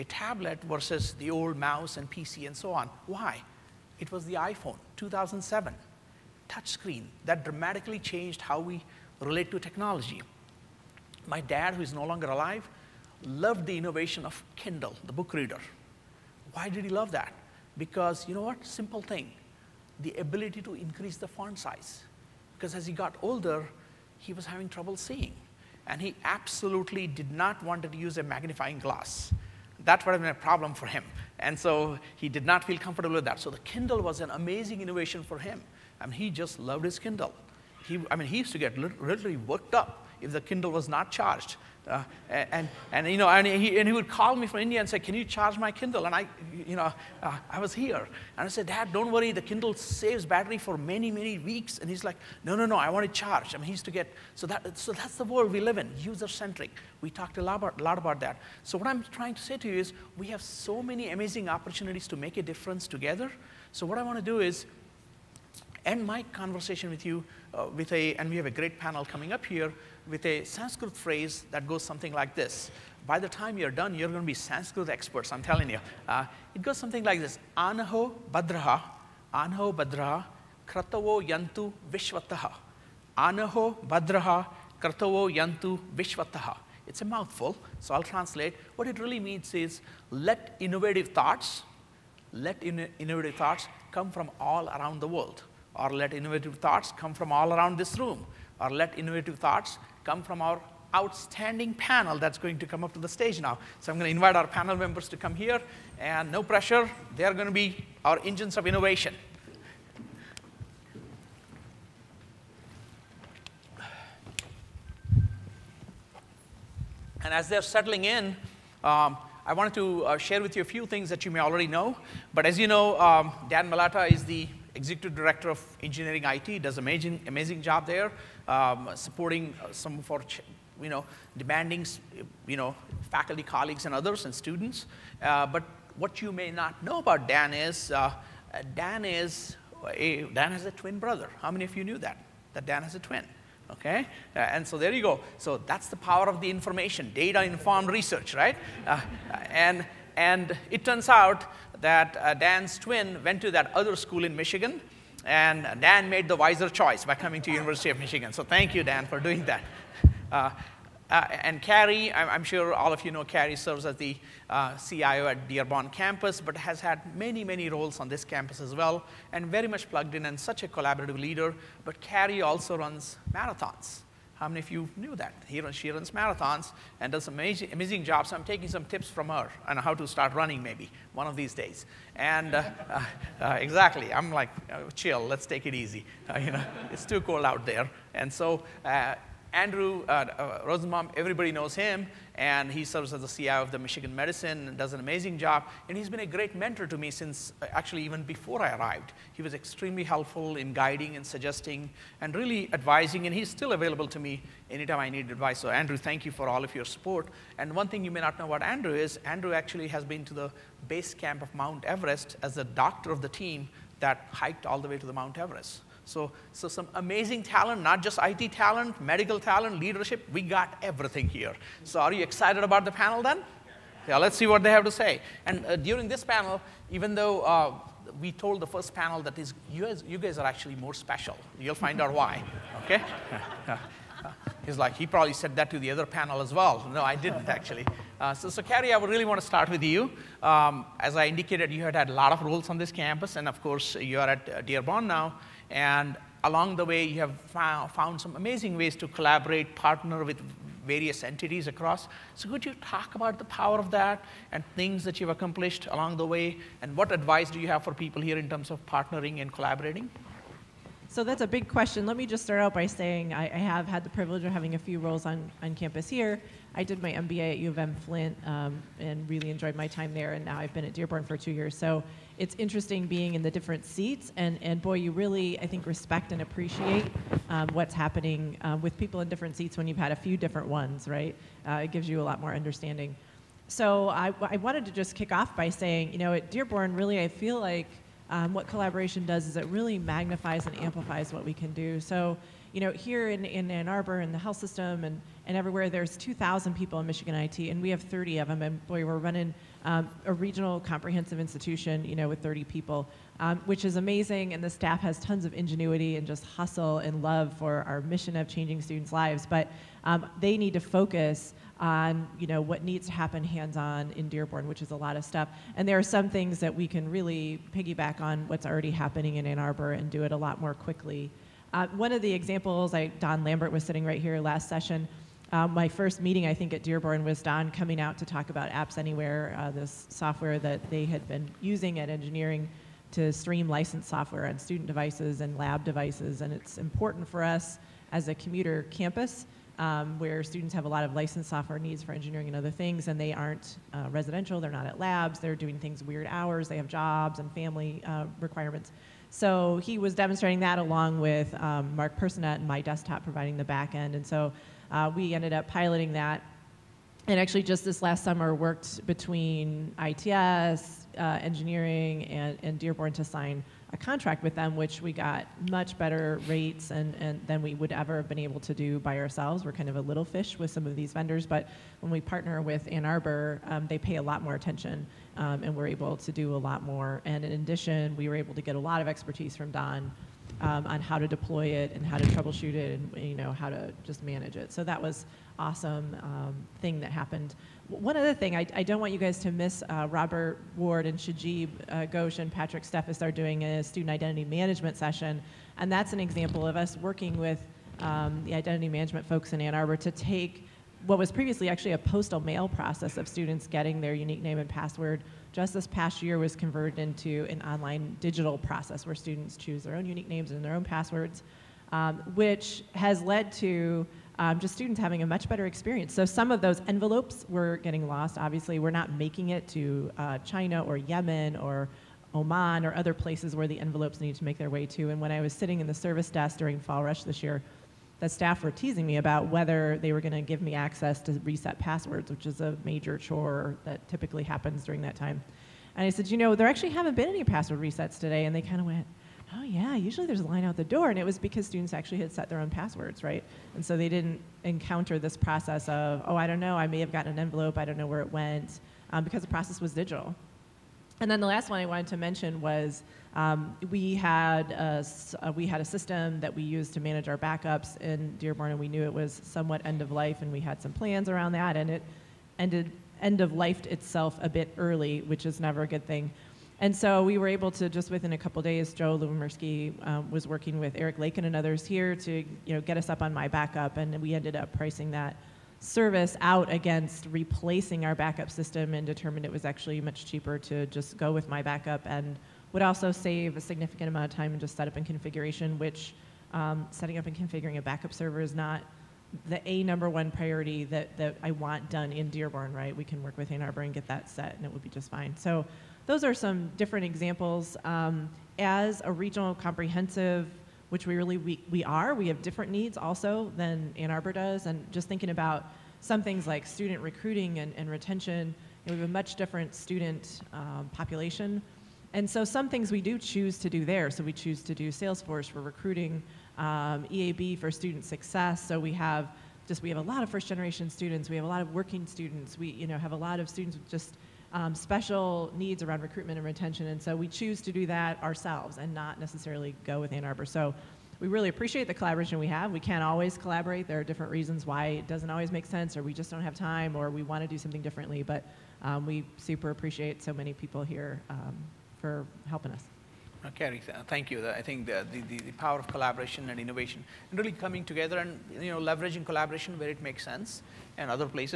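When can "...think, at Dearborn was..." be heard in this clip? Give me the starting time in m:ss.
5:26.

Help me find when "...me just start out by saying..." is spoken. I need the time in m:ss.
4:22.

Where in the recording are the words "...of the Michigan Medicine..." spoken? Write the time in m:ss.
3:13.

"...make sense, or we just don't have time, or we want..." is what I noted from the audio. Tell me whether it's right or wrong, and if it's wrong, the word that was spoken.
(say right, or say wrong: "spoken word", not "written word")
right.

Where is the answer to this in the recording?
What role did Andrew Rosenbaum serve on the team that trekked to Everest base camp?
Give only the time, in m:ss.
3:32.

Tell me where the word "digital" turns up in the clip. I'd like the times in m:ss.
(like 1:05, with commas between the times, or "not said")
6:48, 7:29.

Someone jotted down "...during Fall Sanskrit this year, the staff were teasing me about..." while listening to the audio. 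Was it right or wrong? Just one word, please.
wrong.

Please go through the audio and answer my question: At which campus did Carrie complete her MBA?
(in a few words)
U of M Flint.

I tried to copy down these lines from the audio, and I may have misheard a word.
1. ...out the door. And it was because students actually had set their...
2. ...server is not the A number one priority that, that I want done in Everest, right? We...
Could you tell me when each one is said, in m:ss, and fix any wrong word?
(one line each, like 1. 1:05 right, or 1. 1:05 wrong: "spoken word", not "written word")
1. 7:20 right
2. 8:08 wrong: "Dearborn", not "Everest".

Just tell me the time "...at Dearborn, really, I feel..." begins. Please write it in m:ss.
4:46.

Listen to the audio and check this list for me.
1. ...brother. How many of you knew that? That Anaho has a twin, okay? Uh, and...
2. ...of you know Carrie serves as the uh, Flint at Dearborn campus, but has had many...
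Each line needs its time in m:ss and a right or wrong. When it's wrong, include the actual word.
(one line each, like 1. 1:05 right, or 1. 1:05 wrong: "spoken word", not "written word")
1. 2:20 wrong: "Dan", not "Anaho"
2. 2:42 wrong: "CIO", not "Flint".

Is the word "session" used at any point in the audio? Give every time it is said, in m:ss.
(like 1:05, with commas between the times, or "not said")
5:24, 6:34.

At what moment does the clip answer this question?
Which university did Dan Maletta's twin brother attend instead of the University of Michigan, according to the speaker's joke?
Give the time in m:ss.
2:33.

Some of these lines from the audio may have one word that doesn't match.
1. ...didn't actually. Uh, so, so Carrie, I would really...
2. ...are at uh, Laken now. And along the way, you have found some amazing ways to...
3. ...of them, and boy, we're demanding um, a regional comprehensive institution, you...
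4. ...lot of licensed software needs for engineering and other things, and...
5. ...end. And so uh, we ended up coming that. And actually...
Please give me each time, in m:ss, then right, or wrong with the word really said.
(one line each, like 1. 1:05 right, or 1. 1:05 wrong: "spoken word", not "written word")
1. 3:57 right
2. 4:04 wrong: "Dearborn", not "Laken"
3. 4:58 wrong: "running", not "demanding"
4. 5:40 right
5. 5:53 wrong: "piloting", not "coming".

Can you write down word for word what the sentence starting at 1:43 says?
So I'm going to invite our panel members to come here.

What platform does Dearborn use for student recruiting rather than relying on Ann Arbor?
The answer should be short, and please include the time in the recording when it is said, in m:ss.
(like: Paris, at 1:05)
Salesforce, at 8:34.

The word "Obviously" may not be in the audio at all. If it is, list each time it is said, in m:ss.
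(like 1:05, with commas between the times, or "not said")
6:58.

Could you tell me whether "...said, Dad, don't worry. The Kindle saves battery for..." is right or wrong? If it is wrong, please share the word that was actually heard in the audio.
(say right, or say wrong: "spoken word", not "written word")
right.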